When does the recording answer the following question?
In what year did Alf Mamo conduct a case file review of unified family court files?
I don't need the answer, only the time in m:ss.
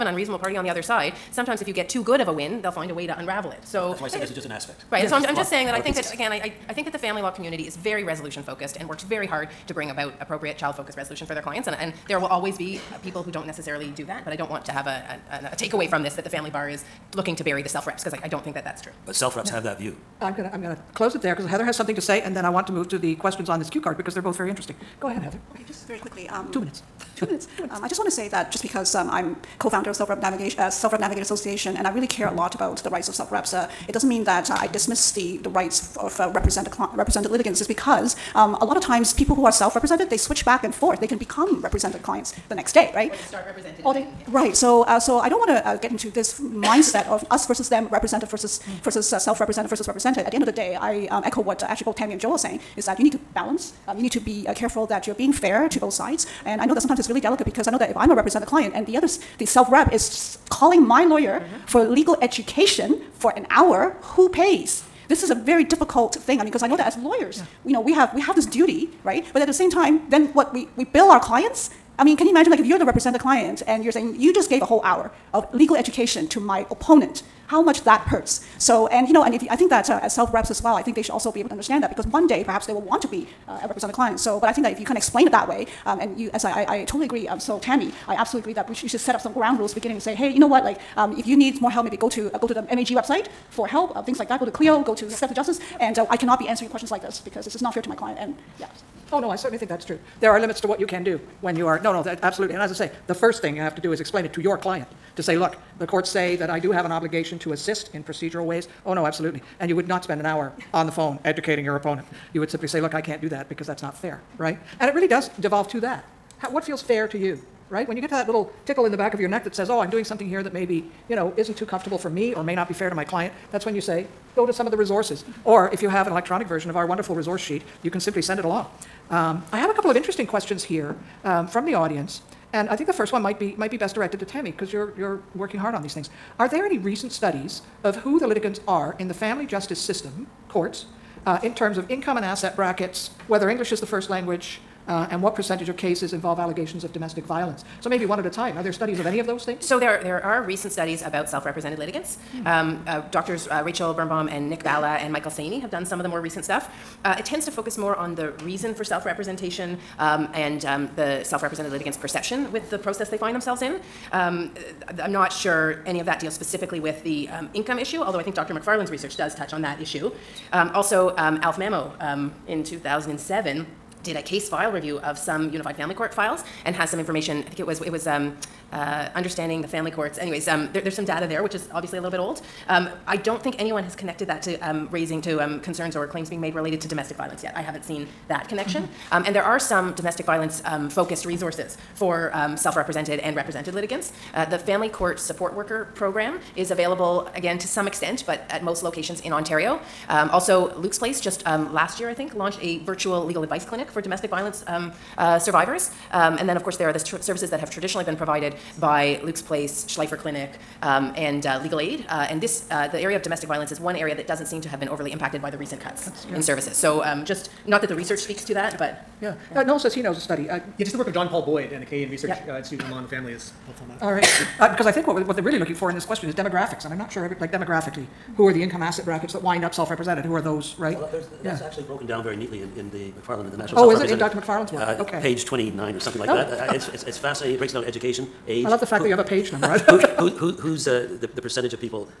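2:52.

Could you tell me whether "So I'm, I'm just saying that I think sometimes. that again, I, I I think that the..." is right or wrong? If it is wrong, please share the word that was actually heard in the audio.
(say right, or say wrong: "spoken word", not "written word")
wrong: "pieces", not "sometimes".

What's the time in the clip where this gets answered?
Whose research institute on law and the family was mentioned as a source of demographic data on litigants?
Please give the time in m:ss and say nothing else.
3:41.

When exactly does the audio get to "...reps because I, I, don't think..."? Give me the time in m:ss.
0:17.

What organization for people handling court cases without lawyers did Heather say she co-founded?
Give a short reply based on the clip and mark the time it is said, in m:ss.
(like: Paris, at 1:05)
Self Rep Navigator Association, at 0:30.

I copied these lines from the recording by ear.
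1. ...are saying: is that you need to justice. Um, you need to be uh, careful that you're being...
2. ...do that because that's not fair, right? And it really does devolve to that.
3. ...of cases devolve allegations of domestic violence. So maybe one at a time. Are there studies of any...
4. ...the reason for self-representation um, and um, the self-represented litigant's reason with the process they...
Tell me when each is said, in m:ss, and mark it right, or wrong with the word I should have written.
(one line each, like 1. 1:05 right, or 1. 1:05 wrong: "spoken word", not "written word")
1. 0:52 wrong: "balance", not "justice"
2. 1:53 right
3. 2:25 wrong: "involve", not "devolve"
4. 2:38 wrong: "perception", not "reason".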